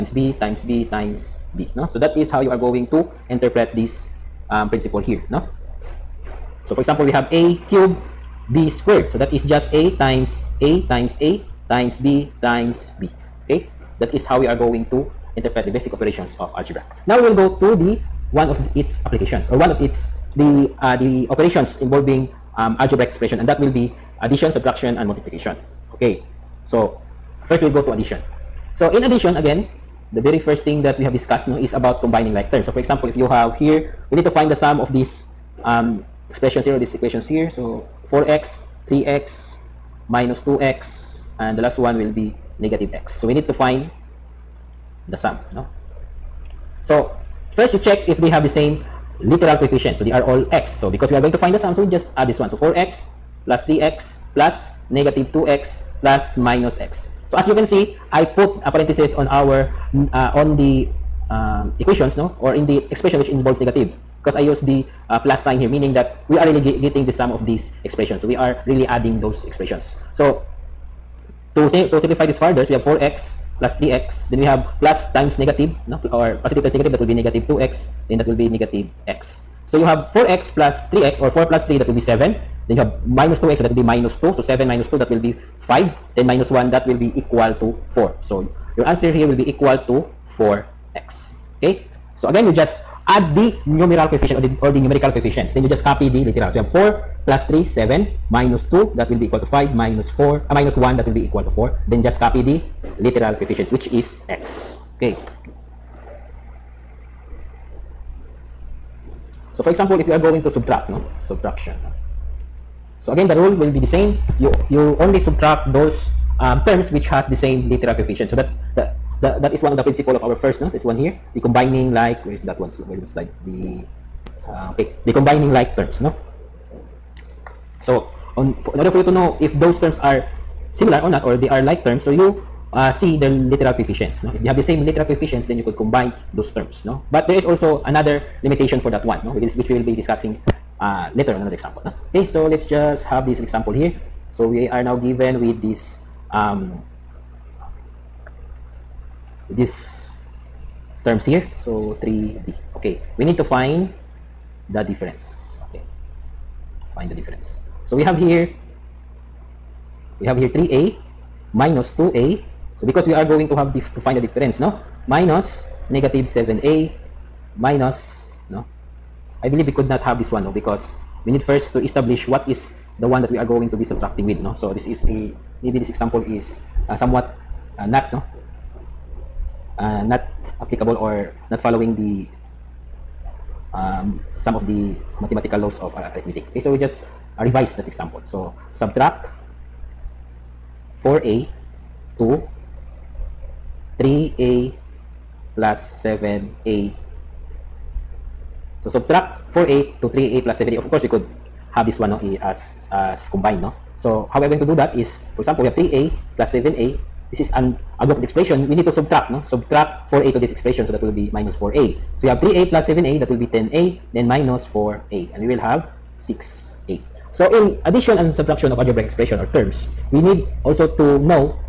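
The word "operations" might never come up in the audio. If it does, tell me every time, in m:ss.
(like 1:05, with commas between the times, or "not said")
0:15, 0:21.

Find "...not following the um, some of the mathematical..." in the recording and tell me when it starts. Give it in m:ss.
3:01.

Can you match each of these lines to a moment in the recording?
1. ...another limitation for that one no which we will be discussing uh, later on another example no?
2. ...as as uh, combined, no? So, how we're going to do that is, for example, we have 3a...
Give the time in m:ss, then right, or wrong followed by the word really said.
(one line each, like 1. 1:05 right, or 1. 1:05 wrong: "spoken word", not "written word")
1. 2:17 right
2. 3:22 right.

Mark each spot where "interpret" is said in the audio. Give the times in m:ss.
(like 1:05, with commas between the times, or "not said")
0:03, 0:15.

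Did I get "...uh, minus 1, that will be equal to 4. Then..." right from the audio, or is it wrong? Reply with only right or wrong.
right.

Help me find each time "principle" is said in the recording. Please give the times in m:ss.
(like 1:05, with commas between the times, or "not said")
0:04, 1:59.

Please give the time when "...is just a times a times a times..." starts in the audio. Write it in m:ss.
0:09.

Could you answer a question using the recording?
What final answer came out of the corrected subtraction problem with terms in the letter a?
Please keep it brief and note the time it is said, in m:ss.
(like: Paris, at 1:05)
6a, at 3:36.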